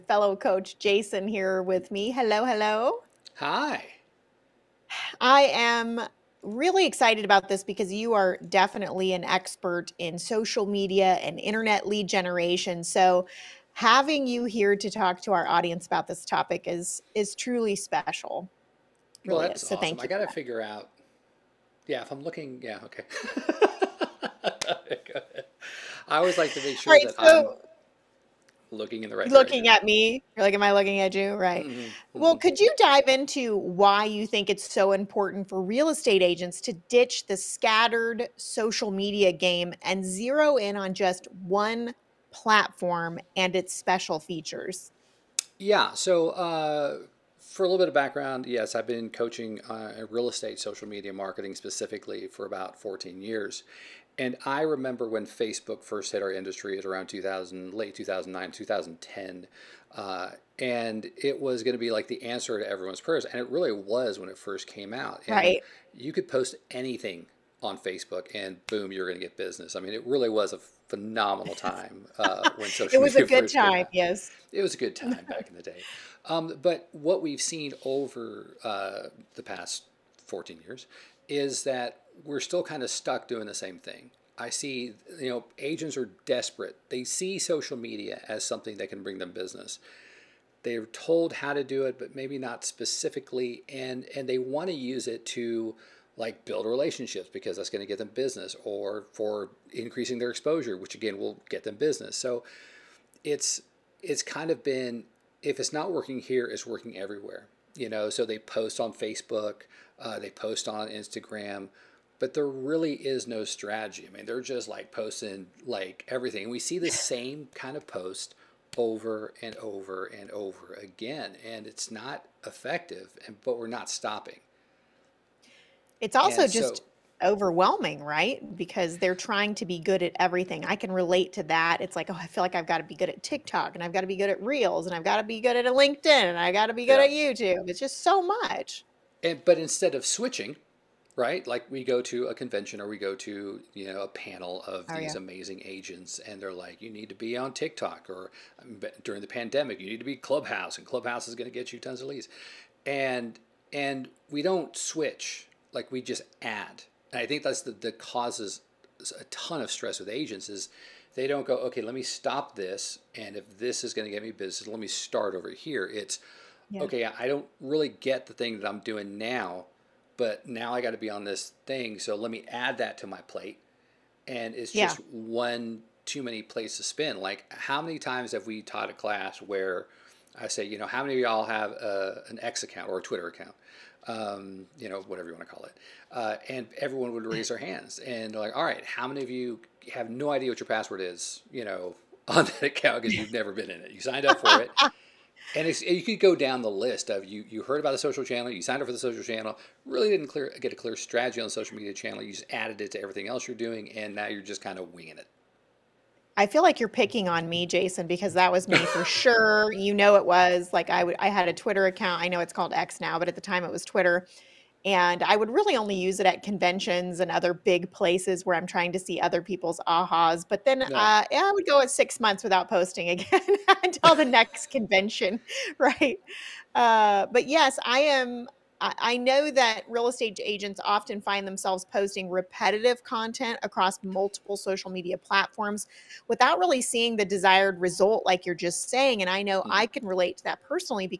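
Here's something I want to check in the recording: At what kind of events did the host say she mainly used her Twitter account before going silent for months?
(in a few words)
Conventions.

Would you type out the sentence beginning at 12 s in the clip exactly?
So having you here to talk to our audience about this topic is is truly special.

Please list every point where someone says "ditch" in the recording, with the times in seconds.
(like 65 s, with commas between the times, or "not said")
36 s.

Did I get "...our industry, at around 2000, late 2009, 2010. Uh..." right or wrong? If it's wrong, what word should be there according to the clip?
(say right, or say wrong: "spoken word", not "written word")
right.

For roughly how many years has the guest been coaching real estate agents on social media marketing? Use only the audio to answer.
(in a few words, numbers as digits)
14.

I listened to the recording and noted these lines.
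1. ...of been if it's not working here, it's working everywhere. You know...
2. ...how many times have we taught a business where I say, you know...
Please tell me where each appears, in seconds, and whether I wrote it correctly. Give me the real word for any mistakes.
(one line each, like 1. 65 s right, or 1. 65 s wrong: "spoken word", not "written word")
1. 104 s right
2. 177 s wrong: "class", not "business".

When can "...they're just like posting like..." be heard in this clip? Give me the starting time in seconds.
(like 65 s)
114 s.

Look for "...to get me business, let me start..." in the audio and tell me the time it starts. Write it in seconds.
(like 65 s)
164 s.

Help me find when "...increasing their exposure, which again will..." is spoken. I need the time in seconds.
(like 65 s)
99 s.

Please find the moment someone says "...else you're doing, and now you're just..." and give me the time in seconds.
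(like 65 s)
203 s.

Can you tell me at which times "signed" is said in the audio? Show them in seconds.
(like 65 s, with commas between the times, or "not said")
194 s, 198 s.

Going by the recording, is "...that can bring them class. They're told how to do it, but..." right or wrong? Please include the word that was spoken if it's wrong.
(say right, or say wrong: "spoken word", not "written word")
wrong: "business", not "class".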